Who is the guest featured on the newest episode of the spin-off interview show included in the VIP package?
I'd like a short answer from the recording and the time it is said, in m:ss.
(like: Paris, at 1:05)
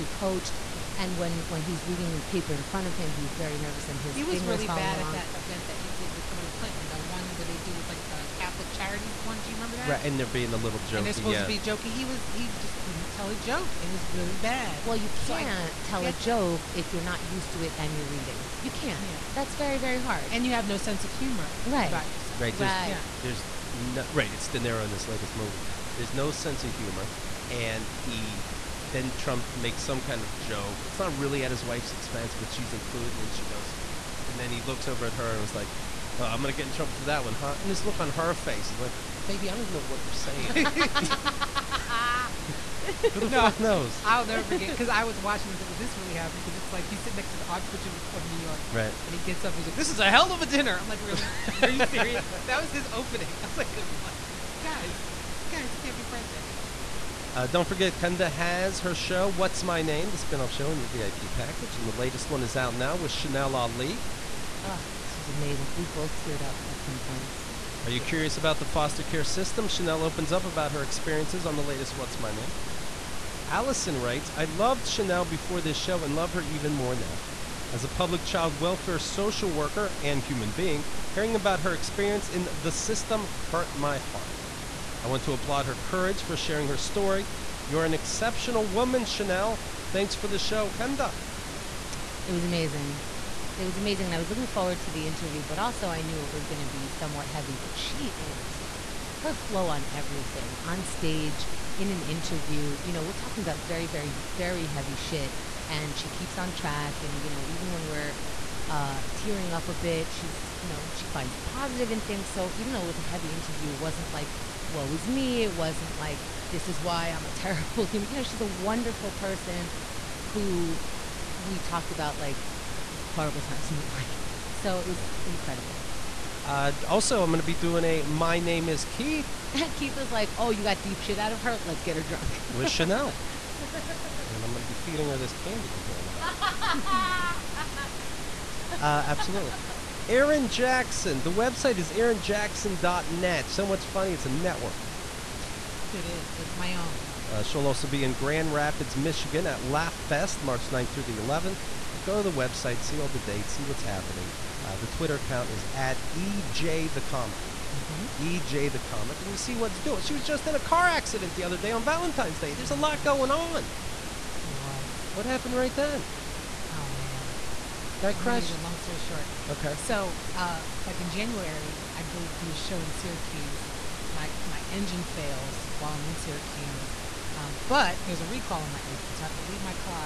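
Chanel Ali, at 1:03.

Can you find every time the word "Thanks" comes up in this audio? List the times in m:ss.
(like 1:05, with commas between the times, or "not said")
1:29.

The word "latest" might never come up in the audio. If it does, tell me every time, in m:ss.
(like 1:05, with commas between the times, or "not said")
0:25, 1:01, 1:11.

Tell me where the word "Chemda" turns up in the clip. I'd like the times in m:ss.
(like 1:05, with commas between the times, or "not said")
0:57, 1:30.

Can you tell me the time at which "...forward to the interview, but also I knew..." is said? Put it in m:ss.
1:34.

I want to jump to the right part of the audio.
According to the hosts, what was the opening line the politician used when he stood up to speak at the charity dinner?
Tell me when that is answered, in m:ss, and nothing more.
0:49.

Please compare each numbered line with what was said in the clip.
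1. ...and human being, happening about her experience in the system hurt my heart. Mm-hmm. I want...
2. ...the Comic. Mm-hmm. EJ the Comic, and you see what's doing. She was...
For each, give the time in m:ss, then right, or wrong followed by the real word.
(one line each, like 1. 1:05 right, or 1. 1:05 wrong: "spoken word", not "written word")
1. 1:19 wrong: "hearing", not "happening"
2. 2:36 right.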